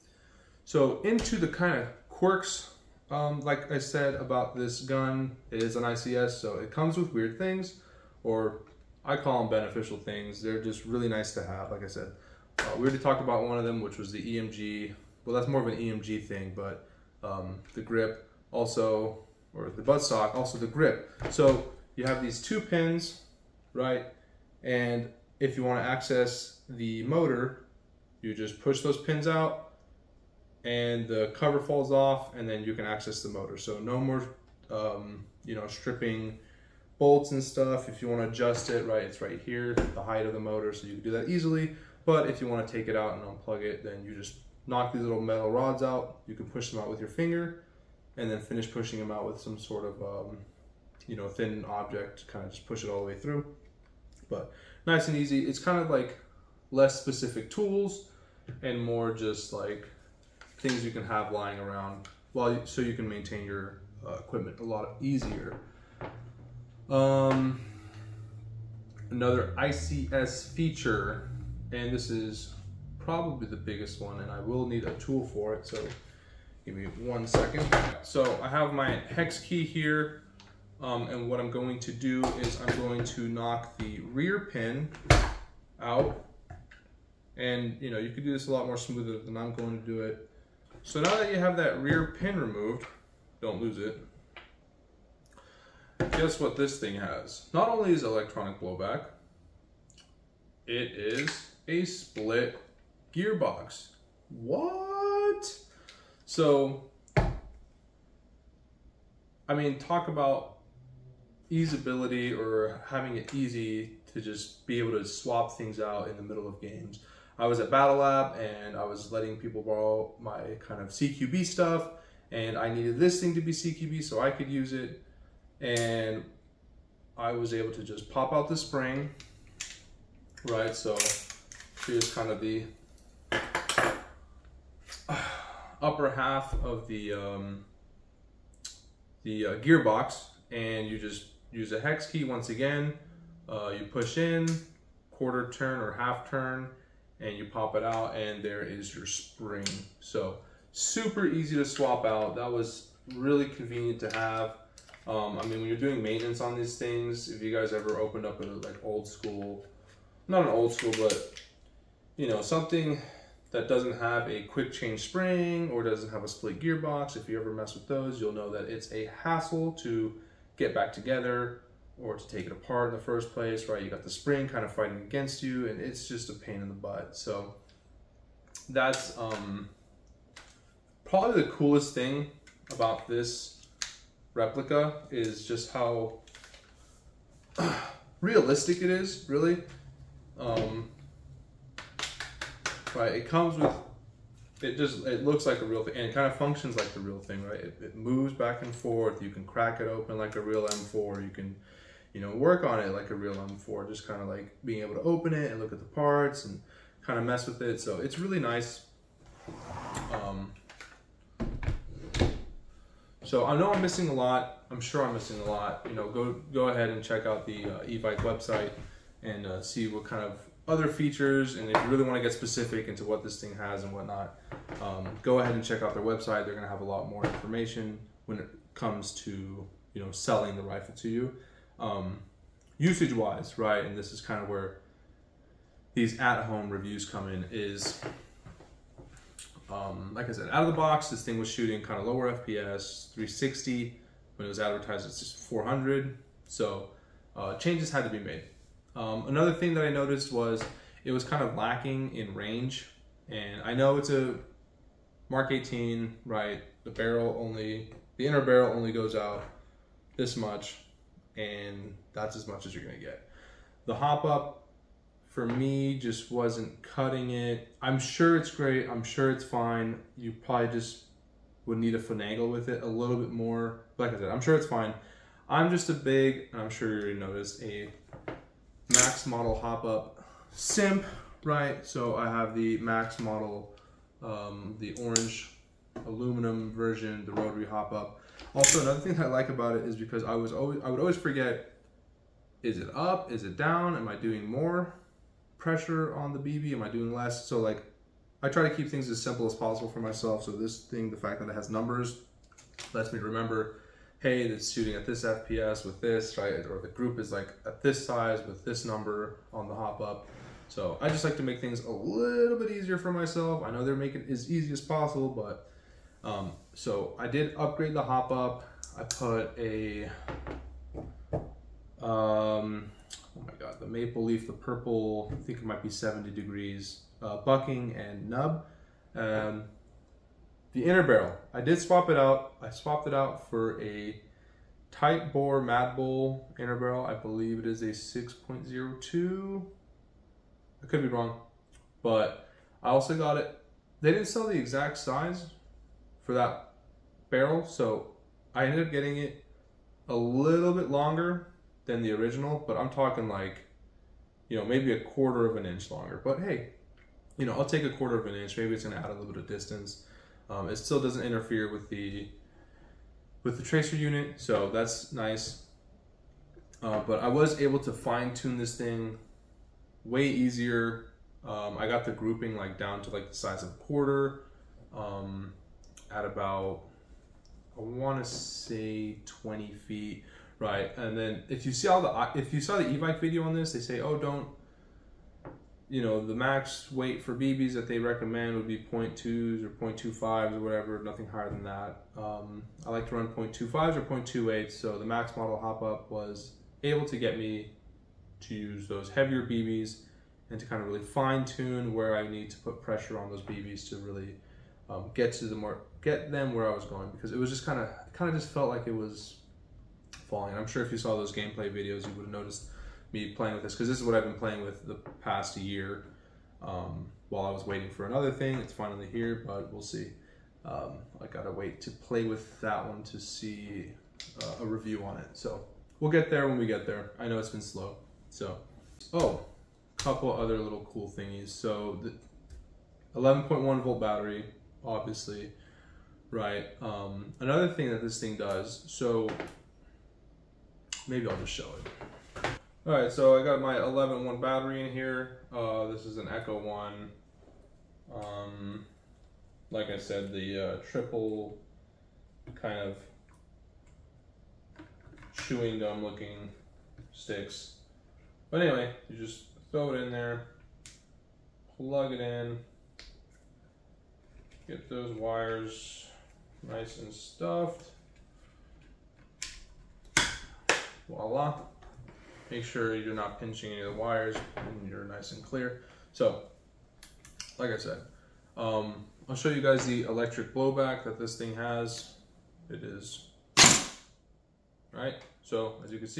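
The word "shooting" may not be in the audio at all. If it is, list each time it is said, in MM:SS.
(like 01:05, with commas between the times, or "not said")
04:01, 05:04.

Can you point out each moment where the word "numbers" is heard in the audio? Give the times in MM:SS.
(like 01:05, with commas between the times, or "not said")
05:01, 05:08.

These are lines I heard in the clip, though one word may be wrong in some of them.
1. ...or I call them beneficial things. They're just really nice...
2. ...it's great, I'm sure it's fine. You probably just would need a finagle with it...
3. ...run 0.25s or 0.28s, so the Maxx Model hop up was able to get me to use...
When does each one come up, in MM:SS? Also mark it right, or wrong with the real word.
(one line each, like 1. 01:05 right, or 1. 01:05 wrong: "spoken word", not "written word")
1. 00:08 right
2. 04:28 right
3. 06:33 right.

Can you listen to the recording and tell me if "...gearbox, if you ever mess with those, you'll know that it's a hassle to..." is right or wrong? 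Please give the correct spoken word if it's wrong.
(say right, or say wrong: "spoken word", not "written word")
right.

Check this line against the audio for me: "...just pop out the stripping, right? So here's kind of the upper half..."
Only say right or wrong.
wrong.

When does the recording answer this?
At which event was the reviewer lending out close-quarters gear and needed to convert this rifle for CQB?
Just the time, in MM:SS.
01:57.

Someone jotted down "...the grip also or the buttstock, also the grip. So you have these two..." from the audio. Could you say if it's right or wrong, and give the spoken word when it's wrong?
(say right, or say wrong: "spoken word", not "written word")
right.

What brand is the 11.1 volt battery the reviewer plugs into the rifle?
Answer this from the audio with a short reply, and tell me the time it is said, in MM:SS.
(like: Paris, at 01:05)
Echo, at 07:26.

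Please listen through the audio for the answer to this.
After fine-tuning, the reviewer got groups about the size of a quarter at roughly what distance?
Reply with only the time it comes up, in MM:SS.
06:19.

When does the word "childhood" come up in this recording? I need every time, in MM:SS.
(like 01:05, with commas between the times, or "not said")
not said.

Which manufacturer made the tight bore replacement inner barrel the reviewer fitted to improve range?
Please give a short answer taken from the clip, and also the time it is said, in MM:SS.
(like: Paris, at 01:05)
Mad Bull, at 05:35.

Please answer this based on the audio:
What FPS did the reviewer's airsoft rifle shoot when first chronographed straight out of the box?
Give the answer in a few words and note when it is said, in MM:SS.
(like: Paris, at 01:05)
360, at 04:03.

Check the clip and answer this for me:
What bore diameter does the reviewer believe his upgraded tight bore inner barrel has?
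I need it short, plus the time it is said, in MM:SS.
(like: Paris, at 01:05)
6.02, at 05:37.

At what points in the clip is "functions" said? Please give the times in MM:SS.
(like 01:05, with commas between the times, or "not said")
03:16.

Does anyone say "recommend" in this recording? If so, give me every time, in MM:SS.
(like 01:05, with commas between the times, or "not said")
06:27.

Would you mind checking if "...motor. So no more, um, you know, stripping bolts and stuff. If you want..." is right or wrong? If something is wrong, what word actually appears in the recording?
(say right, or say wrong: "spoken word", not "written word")
right.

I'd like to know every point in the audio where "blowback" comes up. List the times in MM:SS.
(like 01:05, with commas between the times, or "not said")
01:38, 08:00.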